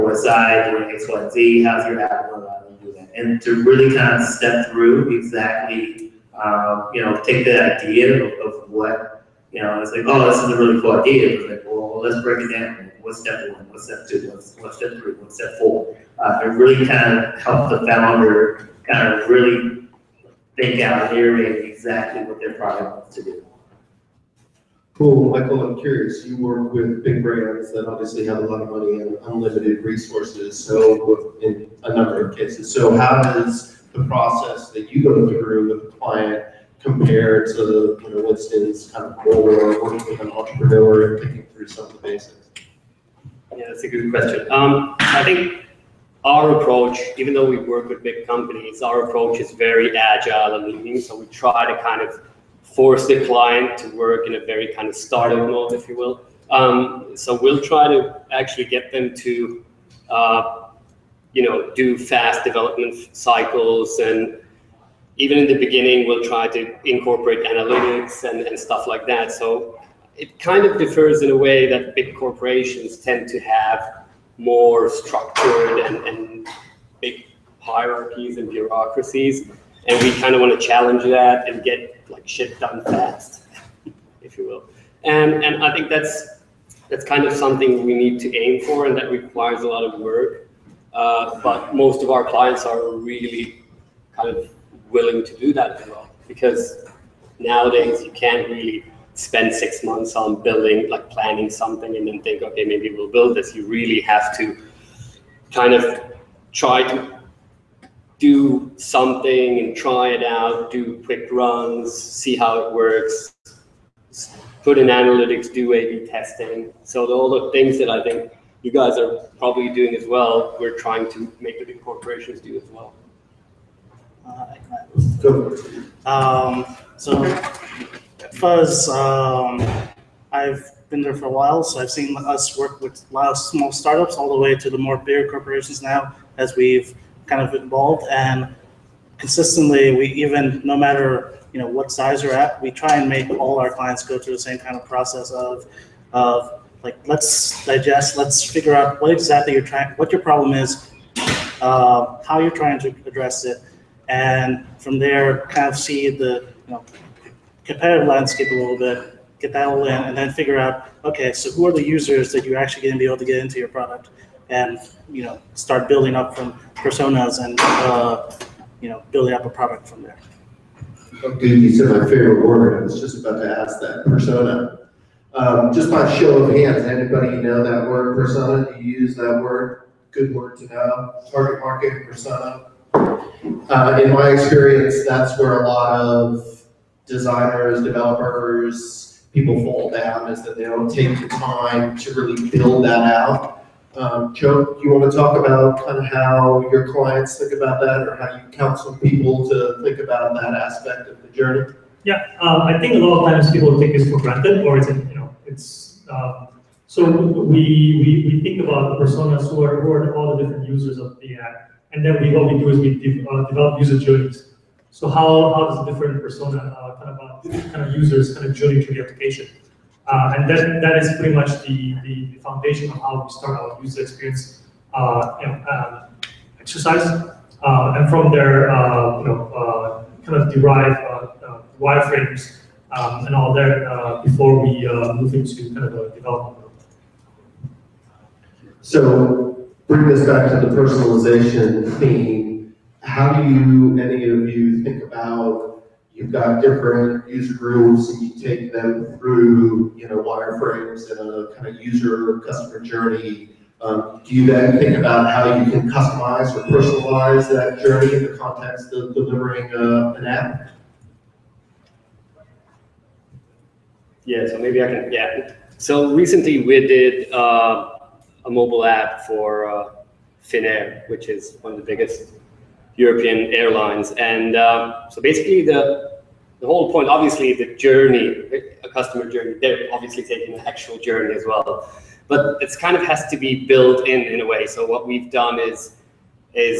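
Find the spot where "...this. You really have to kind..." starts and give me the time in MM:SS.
01:43.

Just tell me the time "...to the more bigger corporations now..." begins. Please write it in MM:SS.
02:14.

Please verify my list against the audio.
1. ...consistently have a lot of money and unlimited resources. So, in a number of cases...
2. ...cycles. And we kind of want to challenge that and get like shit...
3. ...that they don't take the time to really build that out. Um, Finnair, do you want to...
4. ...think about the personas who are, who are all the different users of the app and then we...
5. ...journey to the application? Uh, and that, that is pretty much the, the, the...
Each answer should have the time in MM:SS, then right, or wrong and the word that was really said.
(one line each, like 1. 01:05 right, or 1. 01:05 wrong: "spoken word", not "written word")
1. 00:27 wrong: "obviously", not "consistently"
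2. 01:18 wrong: "bureaucracies", not "cycles"
3. 03:10 wrong: "Joe", not "Finnair"
4. 03:28 right
5. 03:38 right.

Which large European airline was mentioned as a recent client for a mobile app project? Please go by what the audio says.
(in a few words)
Finnair.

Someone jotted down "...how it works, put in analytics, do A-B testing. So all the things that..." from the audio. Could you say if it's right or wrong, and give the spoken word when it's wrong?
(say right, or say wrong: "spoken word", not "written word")
right.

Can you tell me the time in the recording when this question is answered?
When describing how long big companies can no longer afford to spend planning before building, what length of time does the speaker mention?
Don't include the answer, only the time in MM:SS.
01:39.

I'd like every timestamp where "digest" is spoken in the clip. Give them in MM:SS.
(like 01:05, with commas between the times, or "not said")
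02:27.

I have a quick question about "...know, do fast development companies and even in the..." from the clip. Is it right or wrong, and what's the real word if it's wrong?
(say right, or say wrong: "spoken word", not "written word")
wrong: "cycles", not "companies".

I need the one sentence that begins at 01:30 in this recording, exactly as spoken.
Uh, but most of our clients are really kind of willing to do that as well.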